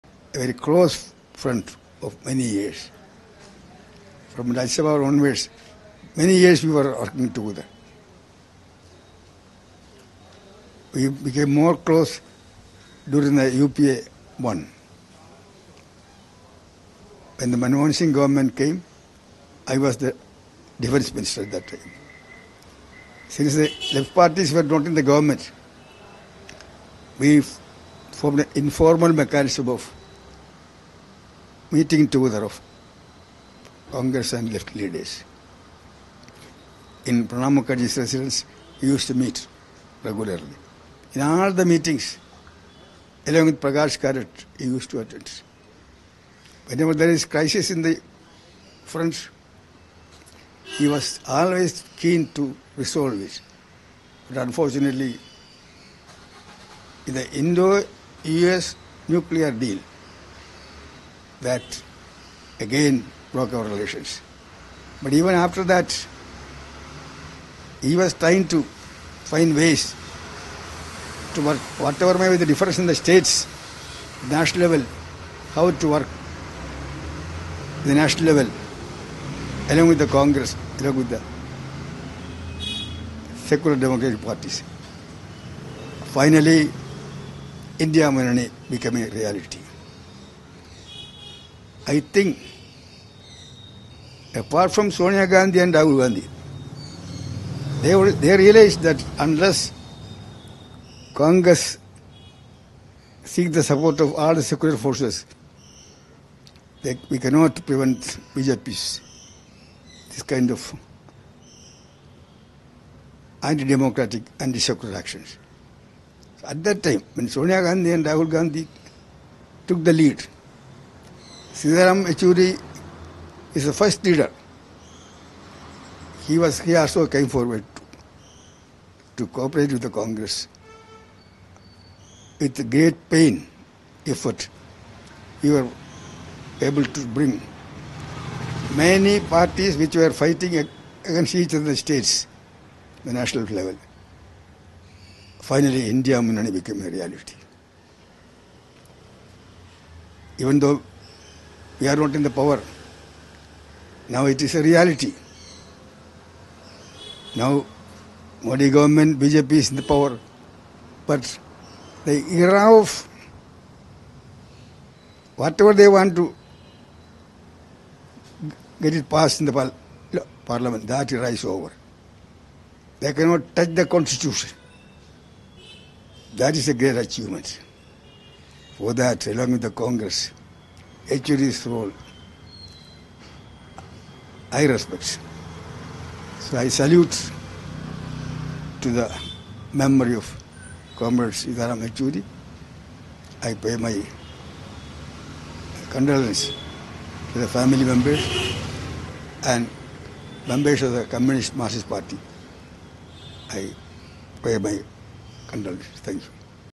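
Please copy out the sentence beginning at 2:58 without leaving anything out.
For that, along with the Congress, Yechury's role.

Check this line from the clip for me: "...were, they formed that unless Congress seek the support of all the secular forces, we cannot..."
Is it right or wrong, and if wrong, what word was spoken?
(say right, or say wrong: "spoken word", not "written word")
wrong: "realized", not "formed".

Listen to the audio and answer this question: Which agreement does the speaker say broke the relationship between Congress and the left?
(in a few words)
Indo-US nuclear deal.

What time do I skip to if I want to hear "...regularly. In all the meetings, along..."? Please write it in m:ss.
0:40.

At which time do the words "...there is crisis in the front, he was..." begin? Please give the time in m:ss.
0:46.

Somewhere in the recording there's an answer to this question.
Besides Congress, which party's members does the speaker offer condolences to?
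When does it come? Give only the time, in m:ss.
3:21.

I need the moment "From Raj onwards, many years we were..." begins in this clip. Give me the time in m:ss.
0:04.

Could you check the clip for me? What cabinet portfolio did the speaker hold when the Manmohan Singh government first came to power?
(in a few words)
Defense minister.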